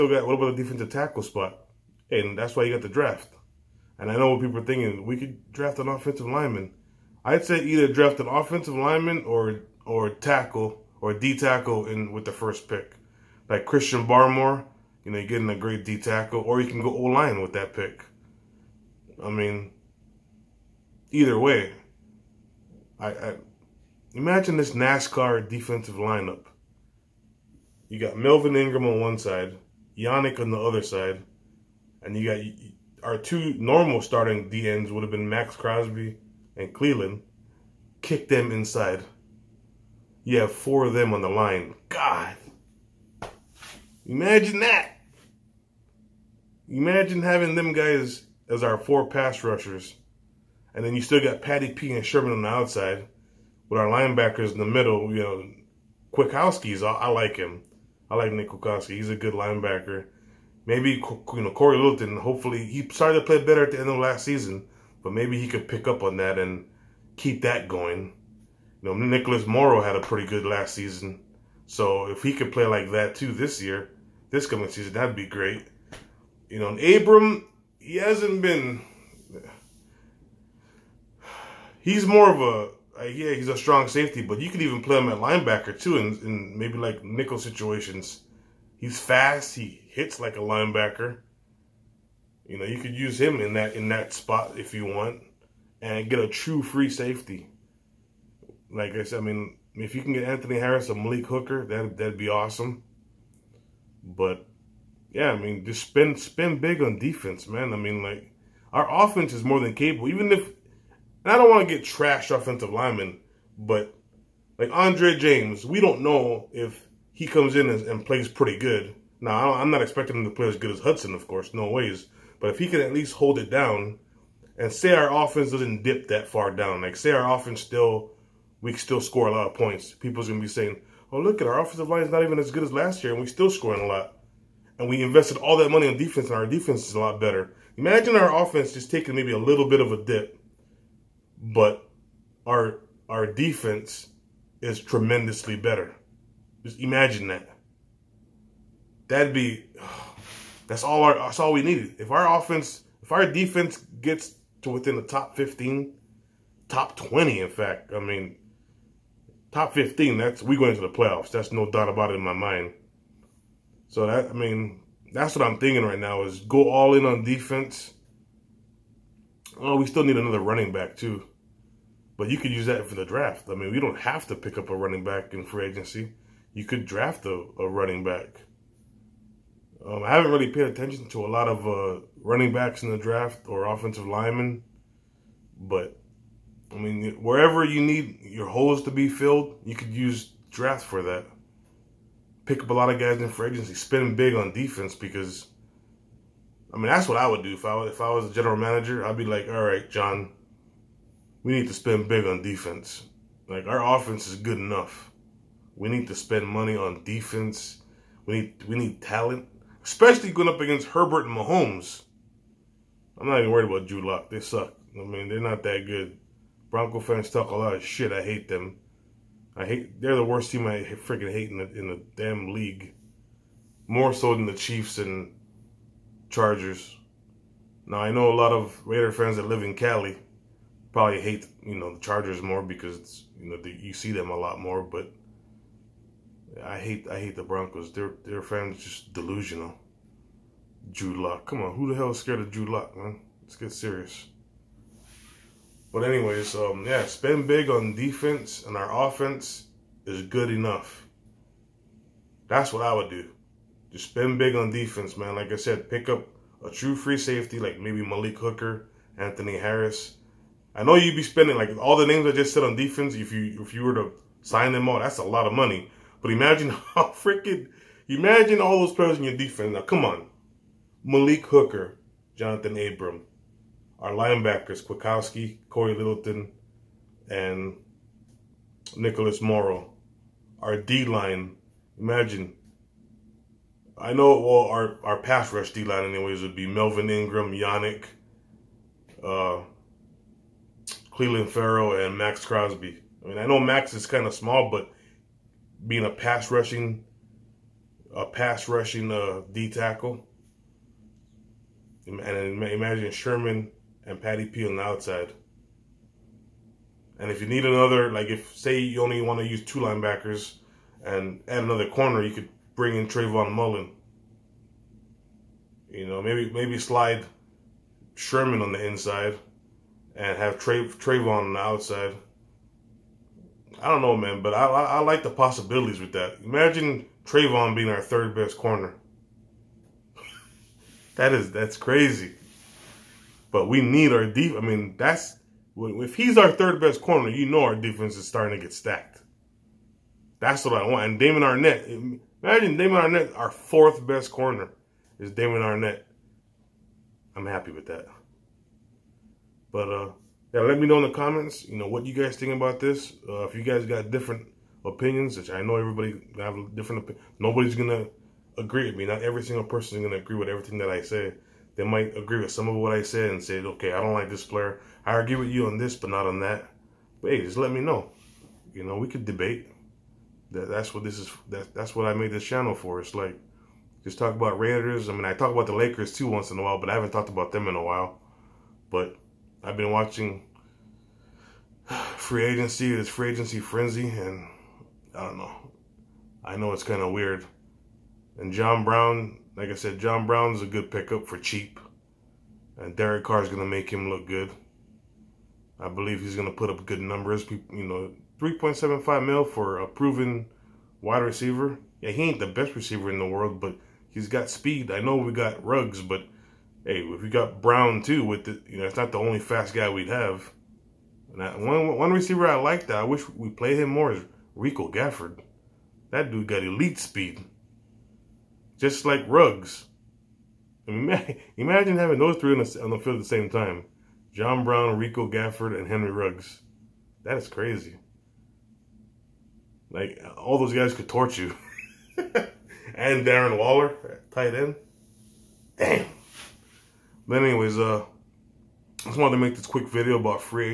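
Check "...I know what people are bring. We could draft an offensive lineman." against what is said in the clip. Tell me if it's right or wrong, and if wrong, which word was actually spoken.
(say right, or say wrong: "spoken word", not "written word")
wrong: "thinking", not "bring".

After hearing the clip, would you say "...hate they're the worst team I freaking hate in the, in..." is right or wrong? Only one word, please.
right.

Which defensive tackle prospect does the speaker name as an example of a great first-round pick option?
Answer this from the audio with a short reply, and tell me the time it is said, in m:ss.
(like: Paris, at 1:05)
Christian Barmore, at 0:13.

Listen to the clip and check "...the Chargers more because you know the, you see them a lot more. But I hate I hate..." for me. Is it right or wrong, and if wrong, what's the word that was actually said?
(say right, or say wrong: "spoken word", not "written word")
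right.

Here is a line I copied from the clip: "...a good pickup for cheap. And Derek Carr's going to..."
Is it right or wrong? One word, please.
right.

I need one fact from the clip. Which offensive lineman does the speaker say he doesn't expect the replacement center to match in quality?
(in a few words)
Hudson.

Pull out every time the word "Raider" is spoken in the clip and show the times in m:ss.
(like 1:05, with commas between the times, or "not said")
3:48, 6:14.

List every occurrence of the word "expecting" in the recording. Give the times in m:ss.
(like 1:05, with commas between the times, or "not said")
1:59.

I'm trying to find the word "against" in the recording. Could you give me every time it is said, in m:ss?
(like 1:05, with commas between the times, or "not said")
3:30.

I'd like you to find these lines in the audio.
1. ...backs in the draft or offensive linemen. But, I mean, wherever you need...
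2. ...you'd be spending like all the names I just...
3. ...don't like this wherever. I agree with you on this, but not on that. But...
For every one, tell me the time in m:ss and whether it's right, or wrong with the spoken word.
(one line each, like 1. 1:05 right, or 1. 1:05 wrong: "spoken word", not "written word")
1. 3:02 right
2. 4:20 right
3. 6:04 wrong: "player", not "wherever".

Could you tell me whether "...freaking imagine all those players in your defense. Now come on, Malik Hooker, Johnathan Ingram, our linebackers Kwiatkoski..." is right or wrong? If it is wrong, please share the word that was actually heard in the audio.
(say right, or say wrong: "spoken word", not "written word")
wrong: "Abram", not "Ingram".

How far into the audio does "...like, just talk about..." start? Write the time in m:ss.
6:13.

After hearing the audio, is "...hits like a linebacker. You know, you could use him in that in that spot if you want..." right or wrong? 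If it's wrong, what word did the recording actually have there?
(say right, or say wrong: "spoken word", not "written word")
right.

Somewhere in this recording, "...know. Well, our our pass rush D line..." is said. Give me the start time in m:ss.
4:44.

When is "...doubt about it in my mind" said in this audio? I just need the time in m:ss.
2:41.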